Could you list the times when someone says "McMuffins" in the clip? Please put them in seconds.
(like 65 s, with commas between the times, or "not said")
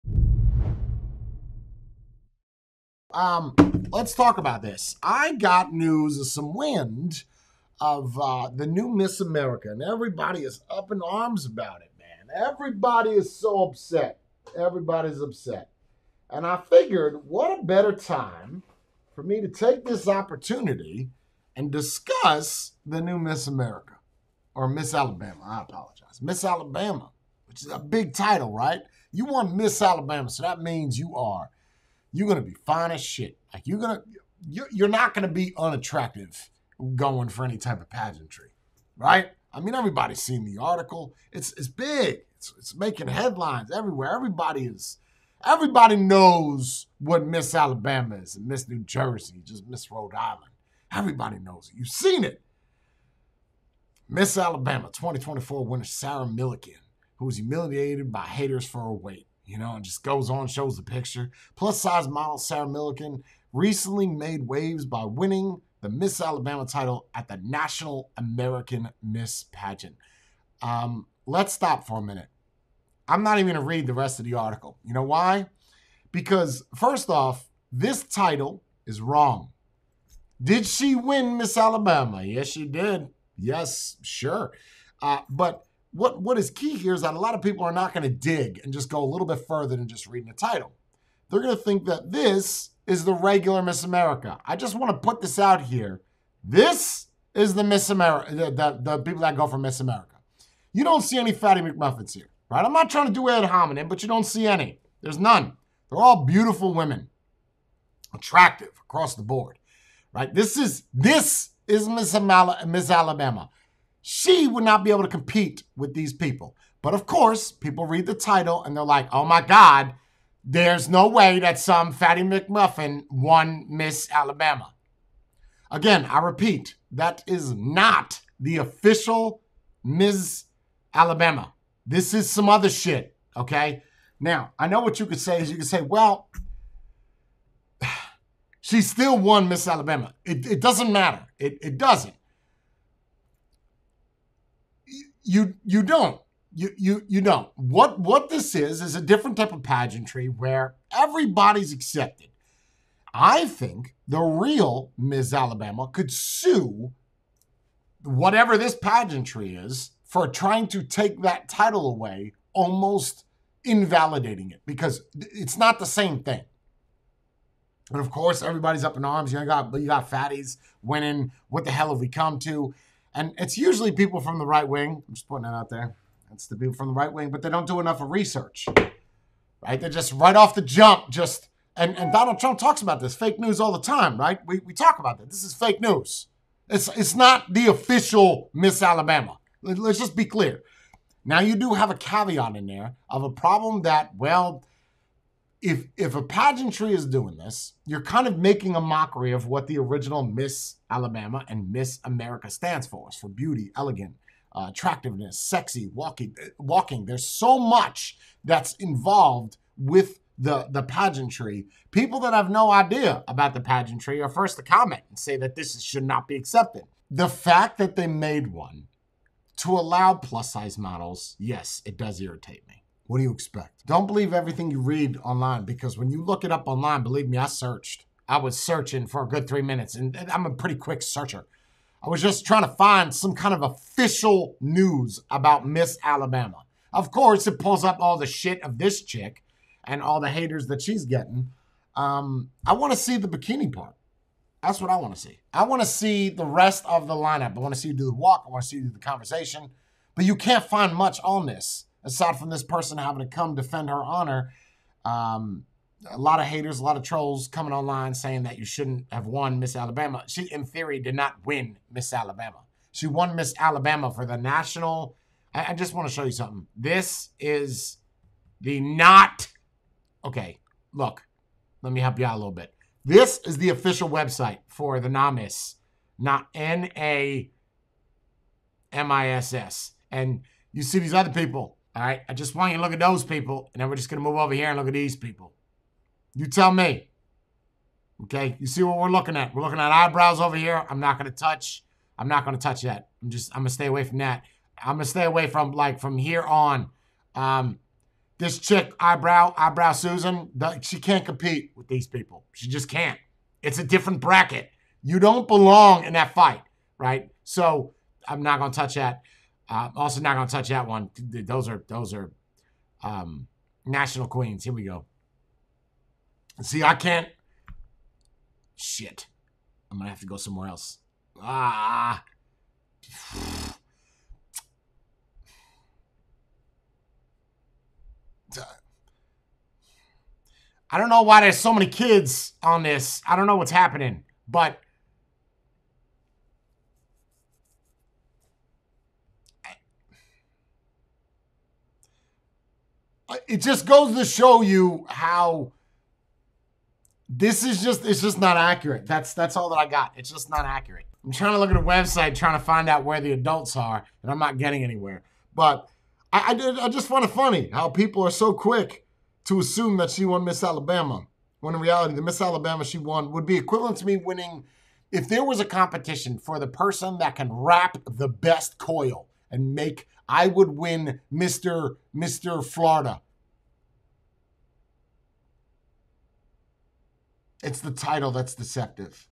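101 s, 122 s.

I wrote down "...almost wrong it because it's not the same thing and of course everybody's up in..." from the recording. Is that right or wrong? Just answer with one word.
wrong.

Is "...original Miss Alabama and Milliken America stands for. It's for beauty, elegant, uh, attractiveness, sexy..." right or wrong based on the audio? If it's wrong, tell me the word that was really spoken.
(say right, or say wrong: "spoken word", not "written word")
wrong: "Miss", not "Milliken".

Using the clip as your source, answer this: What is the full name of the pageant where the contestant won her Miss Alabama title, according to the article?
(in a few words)
National American Miss Pageant.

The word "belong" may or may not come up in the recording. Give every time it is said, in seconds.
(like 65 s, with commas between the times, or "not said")
305 s.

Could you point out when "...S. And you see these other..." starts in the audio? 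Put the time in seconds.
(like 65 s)
279 s.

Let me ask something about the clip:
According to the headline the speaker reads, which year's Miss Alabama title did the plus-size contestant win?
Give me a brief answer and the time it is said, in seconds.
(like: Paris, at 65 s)
2024, at 54 s.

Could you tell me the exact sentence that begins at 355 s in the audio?
But I, I did I just find it funny how people are so quick to assume that she won Miss Alabama.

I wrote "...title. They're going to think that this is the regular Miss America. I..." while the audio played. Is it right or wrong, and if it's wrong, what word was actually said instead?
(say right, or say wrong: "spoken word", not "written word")
right.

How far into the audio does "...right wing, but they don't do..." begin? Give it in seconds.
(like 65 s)
176 s.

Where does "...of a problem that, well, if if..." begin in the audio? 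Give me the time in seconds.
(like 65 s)
193 s.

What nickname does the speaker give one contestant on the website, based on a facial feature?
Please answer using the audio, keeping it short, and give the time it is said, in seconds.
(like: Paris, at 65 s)
eyebrow Susan, at 299 s.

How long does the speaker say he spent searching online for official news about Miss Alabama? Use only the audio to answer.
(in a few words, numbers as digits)
three minutes.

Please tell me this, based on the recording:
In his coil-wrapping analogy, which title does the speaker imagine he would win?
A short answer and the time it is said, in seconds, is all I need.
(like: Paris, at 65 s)
Mr. Florida, at 372 s.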